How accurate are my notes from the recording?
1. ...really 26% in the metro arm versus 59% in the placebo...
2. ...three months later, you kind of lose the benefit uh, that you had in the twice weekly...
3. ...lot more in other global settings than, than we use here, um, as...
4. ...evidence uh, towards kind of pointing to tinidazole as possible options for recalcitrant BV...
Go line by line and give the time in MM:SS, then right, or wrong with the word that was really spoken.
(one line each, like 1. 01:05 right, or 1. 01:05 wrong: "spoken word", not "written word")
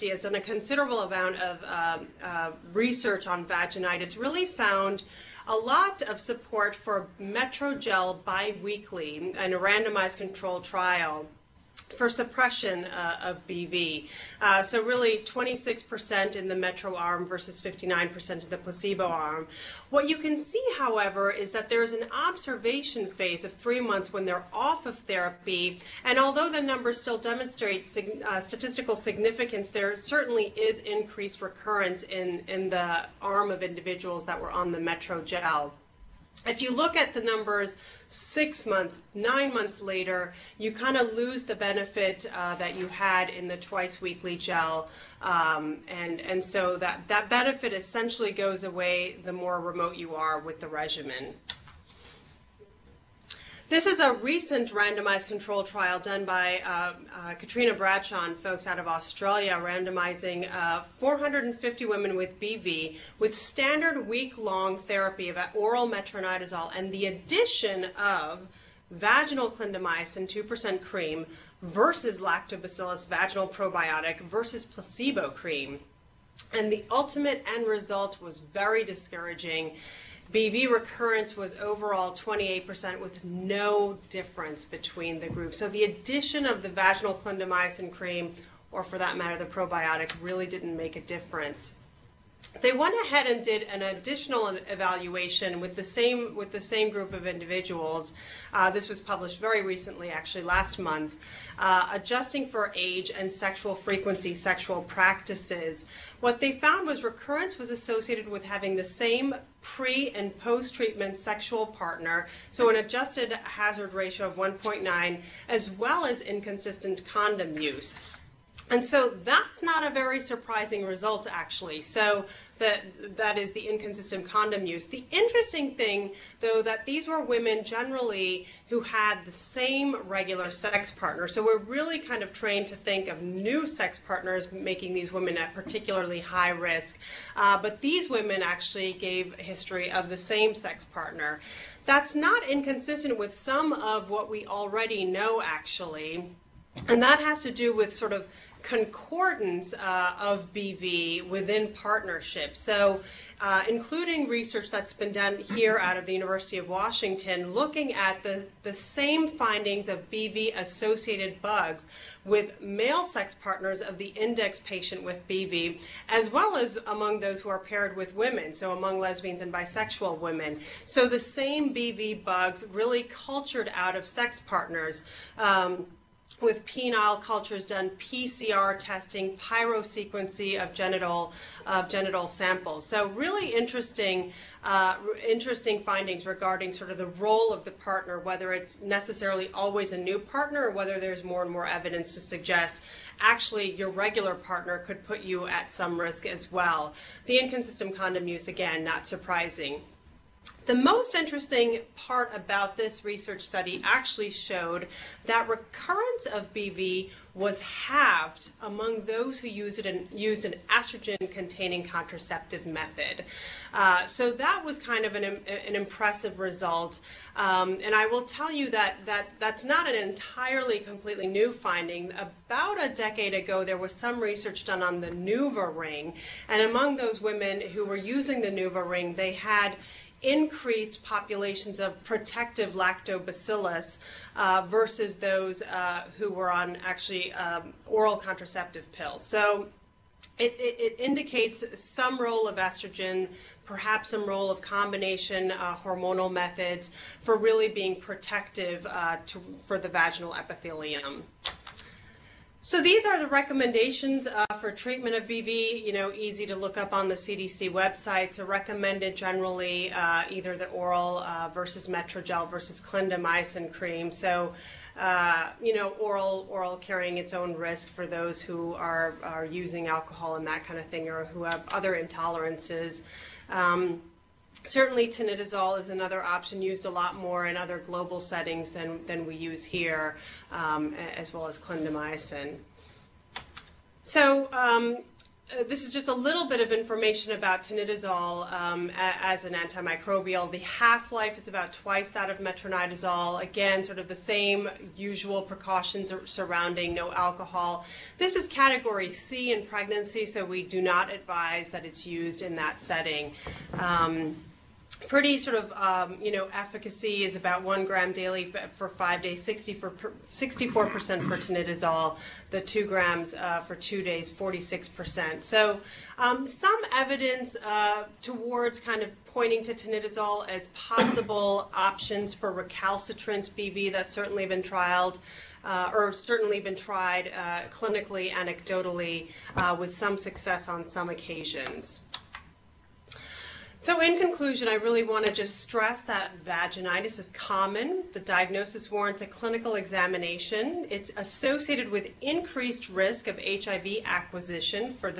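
1. 00:14 right
2. 00:39 wrong: "nine", not "three"
3. 04:36 right
4. 05:16 right.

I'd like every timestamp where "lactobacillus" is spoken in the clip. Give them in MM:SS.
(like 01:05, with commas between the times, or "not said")
01:12, 03:52.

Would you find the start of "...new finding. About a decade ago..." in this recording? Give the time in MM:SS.
03:41.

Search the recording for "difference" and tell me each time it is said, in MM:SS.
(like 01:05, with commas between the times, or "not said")
01:24, 01:30.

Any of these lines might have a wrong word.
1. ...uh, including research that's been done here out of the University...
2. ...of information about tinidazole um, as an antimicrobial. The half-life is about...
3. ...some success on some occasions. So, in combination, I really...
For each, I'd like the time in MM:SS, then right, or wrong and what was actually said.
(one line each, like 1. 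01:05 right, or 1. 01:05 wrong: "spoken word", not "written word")
1. 02:33 right
2. 04:46 right
3. 05:29 wrong: "conclusion", not "combination".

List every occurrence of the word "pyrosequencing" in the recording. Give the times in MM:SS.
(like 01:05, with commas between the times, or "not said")
02:59.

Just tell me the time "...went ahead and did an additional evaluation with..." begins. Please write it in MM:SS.
01:32.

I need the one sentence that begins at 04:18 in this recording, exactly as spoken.
So recommended generally uh, either the oral uh, versus Metrogel versus clindamycin cream.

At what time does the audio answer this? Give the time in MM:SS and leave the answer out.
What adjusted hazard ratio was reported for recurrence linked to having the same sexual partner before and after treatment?
01:54.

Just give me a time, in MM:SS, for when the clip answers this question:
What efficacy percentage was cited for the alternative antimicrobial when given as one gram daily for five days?
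05:09.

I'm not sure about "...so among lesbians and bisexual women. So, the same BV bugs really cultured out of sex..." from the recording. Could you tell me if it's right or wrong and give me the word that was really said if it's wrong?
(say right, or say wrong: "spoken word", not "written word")
right.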